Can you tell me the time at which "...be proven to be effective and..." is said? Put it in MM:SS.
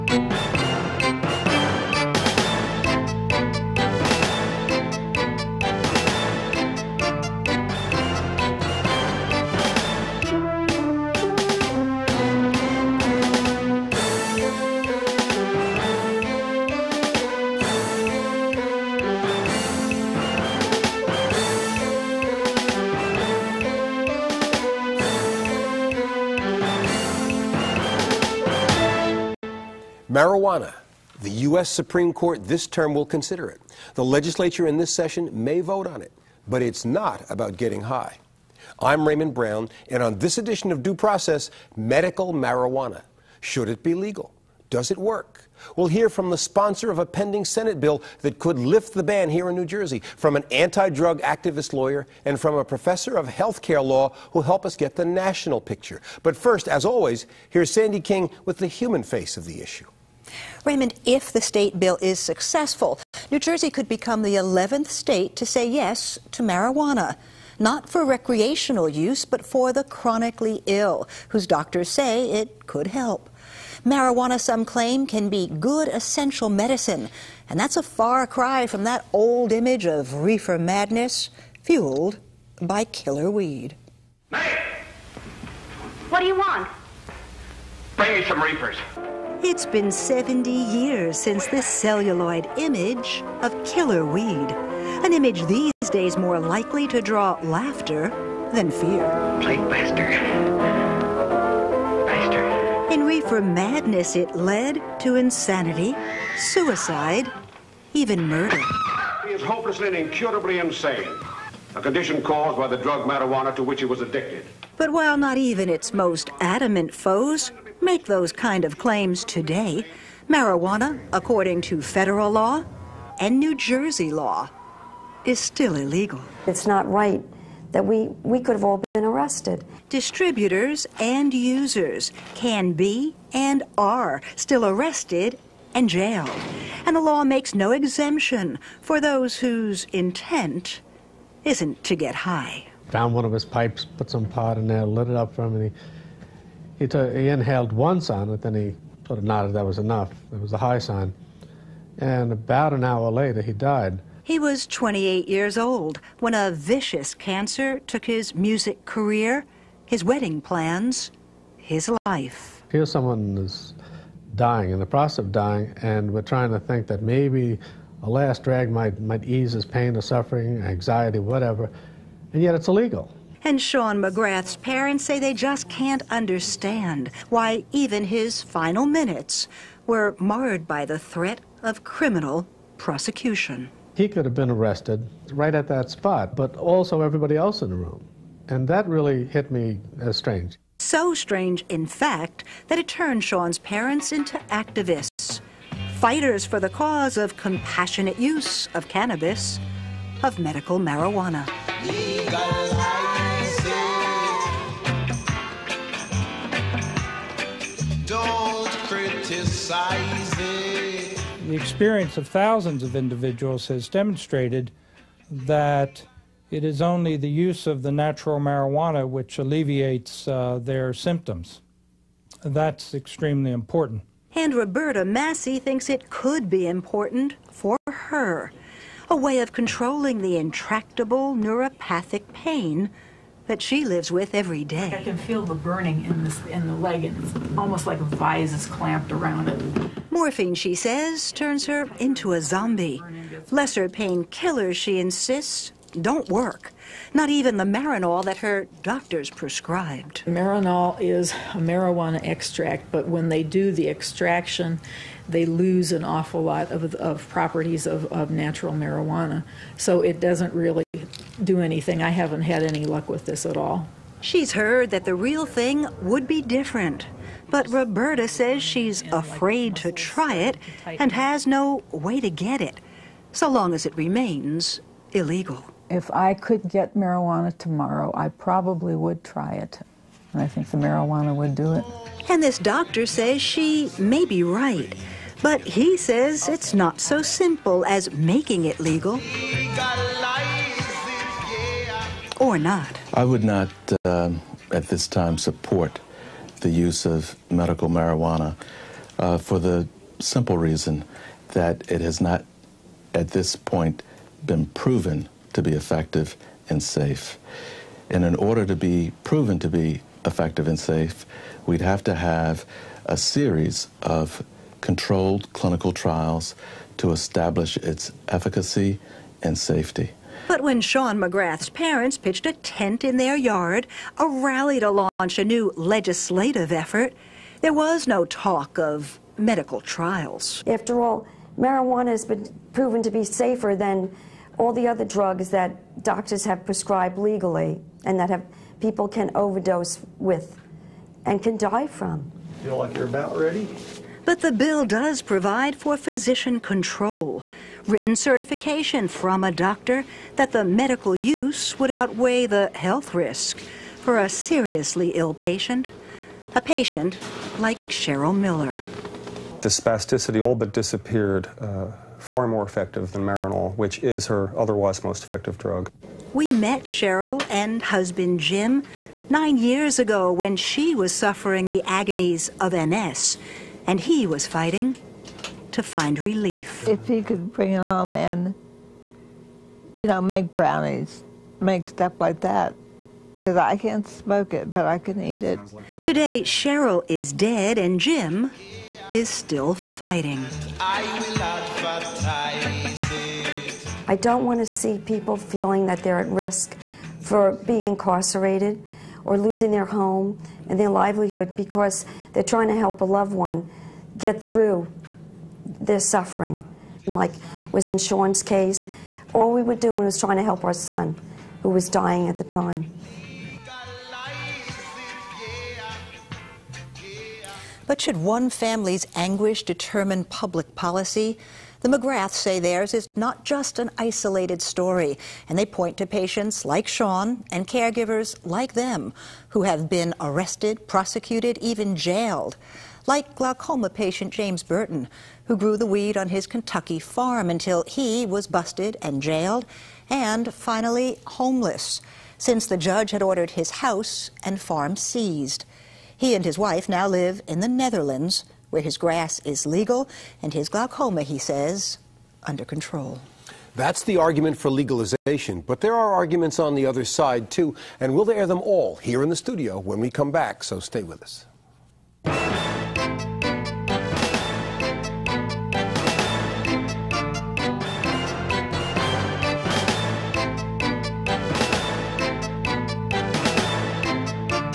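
05:08.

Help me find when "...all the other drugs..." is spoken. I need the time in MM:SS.
05:34.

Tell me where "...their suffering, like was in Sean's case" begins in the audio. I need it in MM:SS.
06:45.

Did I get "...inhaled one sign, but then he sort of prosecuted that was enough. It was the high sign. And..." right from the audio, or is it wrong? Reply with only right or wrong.
wrong.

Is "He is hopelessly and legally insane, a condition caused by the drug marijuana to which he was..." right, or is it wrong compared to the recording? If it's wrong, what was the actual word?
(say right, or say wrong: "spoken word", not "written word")
wrong: "incurably", not "legally".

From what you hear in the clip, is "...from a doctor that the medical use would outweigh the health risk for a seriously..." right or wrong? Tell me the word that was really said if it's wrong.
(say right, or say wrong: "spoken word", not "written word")
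right.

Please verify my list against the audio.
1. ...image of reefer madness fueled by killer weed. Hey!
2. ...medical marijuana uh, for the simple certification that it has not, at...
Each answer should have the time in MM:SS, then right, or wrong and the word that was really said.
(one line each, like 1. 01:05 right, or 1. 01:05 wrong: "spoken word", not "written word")
1. 01:19 right
2. 04:57 wrong: "reason", not "certification".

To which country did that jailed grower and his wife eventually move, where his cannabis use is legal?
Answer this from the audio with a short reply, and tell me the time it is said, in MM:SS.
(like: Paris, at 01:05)
Netherlands, at 07:27.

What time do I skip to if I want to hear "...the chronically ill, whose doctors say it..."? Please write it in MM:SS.
01:09.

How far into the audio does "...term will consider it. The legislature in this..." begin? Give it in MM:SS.
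00:32.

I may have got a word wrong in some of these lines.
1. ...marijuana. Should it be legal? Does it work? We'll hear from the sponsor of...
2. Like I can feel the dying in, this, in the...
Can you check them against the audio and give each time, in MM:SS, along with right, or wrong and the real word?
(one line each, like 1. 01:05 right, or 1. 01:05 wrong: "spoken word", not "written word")
1. 00:42 right
2. 03:54 wrong: "burning", not "dying".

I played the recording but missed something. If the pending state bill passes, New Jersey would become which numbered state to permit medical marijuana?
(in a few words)
11th.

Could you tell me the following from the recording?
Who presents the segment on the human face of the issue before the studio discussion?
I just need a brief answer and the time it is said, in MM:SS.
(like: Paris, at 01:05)
Sandy King, at 00:57.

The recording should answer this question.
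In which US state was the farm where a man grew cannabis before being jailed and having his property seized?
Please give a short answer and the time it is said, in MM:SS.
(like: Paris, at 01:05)
Kentucky, at 07:16.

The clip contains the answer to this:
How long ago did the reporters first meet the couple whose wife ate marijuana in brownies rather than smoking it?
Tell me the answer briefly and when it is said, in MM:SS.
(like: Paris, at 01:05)
9 years, at 06:09.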